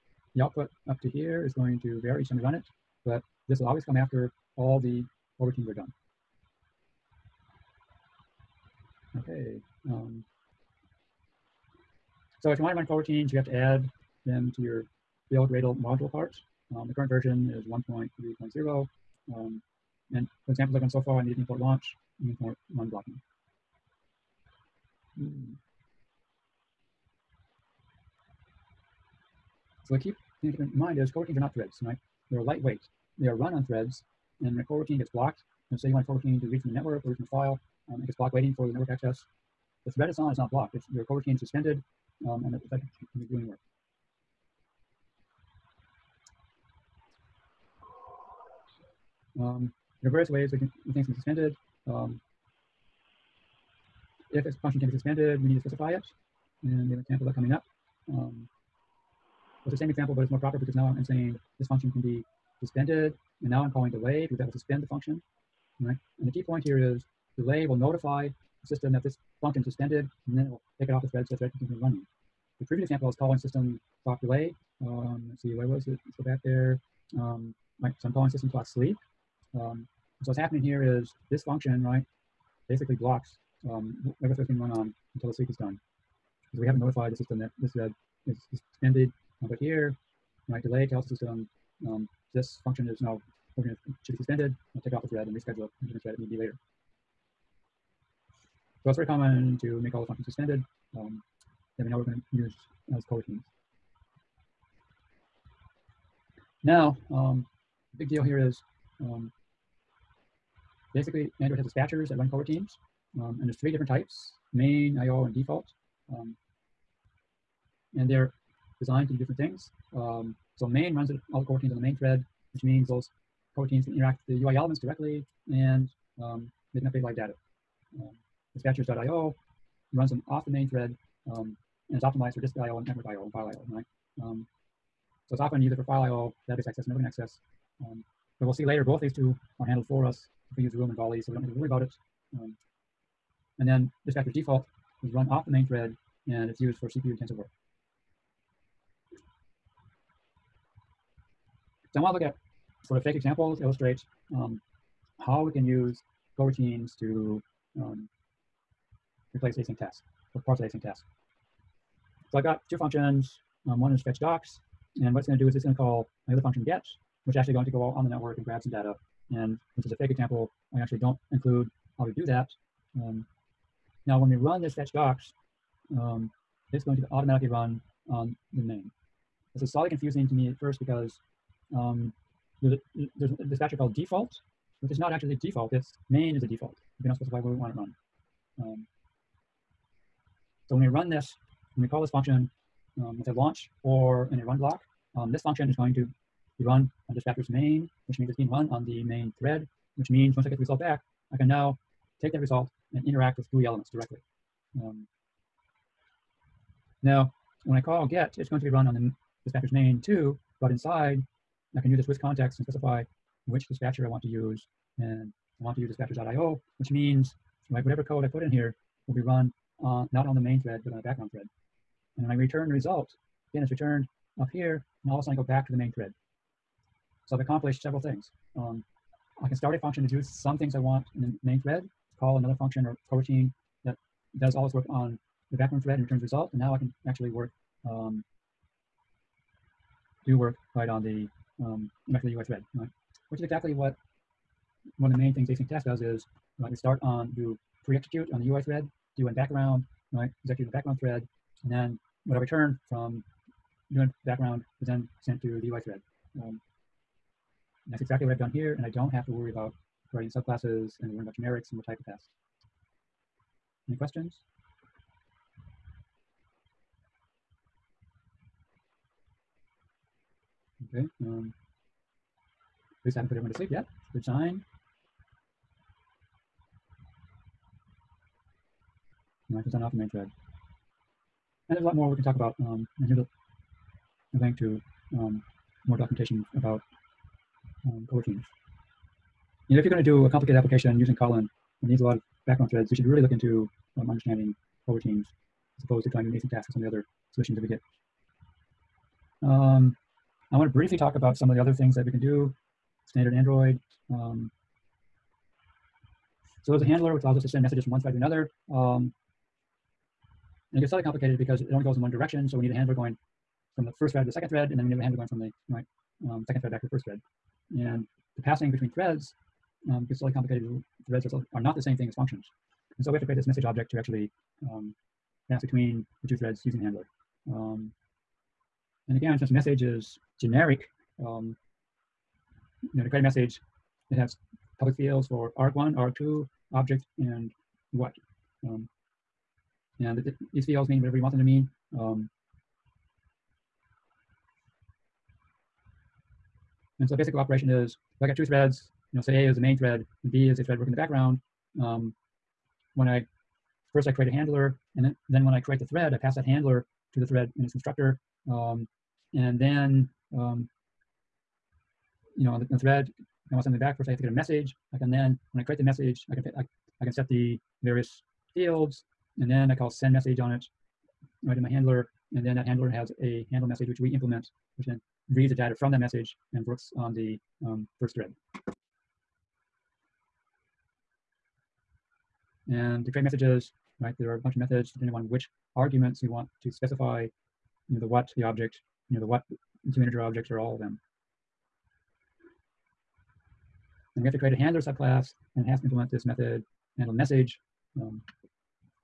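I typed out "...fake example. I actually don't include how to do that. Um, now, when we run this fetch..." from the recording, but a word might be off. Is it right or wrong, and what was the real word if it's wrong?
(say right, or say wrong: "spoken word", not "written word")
right.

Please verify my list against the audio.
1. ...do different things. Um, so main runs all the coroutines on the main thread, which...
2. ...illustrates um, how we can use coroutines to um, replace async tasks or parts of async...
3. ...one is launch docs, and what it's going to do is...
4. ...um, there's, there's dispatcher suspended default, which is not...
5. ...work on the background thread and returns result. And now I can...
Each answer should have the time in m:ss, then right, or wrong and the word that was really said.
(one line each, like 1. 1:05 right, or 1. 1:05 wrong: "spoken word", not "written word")
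1. 1:59 right
2. 2:33 right
3. 2:43 wrong: "fetch", not "launch"
4. 3:01 wrong: "called", not "suspended"
5. 3:54 right.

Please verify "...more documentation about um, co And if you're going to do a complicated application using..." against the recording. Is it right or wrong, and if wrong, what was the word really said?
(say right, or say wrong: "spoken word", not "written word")
right.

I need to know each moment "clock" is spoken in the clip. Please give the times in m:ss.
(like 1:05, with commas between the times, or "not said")
1:14, 1:18.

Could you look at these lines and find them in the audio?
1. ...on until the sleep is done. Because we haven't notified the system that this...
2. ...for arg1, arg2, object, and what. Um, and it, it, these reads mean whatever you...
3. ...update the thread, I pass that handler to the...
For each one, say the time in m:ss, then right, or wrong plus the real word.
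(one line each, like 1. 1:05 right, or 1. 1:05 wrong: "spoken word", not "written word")
1. 1:24 right
2. 5:35 wrong: "fields", not "reads"
3. 5:55 wrong: "create", not "update".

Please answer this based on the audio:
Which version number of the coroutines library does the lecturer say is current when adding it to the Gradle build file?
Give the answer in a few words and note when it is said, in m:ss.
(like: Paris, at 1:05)
1.3.0, at 0:17.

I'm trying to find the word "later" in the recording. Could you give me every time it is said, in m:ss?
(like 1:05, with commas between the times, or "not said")
1:36, 2:18.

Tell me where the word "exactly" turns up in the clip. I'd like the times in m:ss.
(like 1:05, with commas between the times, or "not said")
4:03, 4:18.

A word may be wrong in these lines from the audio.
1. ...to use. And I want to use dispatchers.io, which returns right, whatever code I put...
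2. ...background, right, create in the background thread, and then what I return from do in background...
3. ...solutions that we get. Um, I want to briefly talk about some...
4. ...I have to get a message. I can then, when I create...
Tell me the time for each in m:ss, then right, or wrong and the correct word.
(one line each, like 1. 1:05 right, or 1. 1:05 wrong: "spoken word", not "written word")
1. 3:34 wrong: "means", not "returns"
2. 4:09 wrong: "execute", not "create"
3. 4:57 right
4. 6:04 right.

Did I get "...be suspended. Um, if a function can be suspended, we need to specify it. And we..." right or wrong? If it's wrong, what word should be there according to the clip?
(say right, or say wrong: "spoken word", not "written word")
right.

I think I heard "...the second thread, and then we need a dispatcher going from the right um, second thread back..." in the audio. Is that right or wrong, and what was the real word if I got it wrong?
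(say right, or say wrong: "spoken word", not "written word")
wrong: "handler", not "dispatcher".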